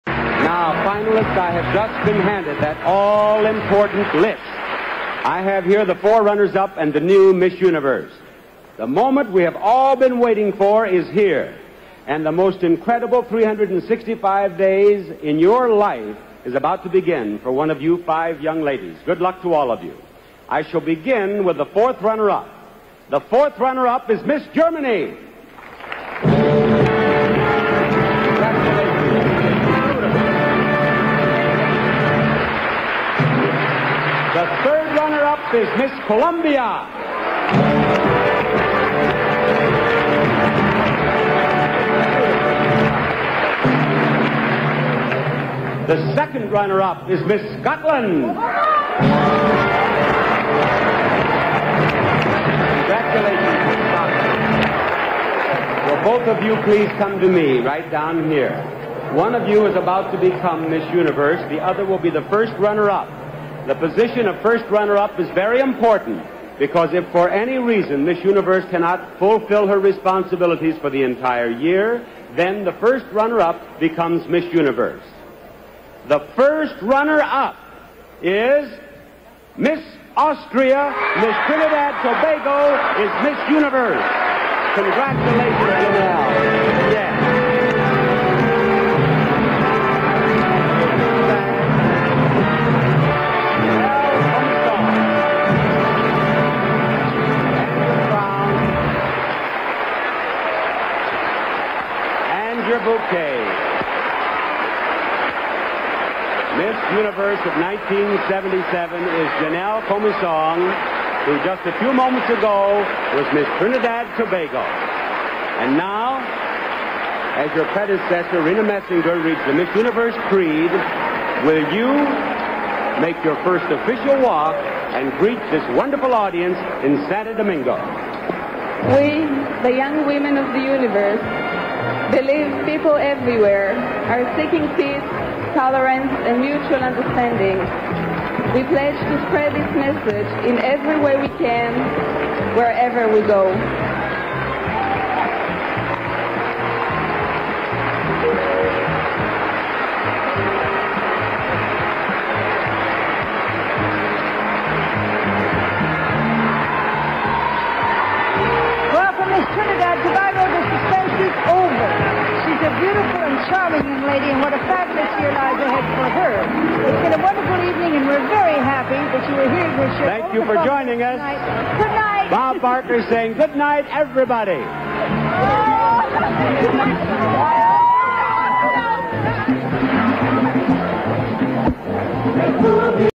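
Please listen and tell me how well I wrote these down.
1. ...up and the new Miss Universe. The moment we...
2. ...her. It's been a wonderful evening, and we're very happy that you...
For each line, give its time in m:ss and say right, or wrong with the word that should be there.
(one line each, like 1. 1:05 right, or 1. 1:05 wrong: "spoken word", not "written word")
1. 0:06 right
2. 2:46 right.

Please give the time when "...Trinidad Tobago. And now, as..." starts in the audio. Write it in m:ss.
1:53.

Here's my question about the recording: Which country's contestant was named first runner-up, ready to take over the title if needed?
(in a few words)
Austria.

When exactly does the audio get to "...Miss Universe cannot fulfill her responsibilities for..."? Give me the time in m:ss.
1:08.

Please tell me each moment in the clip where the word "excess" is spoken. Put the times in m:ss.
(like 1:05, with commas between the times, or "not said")
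not said.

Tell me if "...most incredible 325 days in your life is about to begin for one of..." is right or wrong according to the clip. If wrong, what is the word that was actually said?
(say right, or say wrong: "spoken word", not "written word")
wrong: "365", not "325".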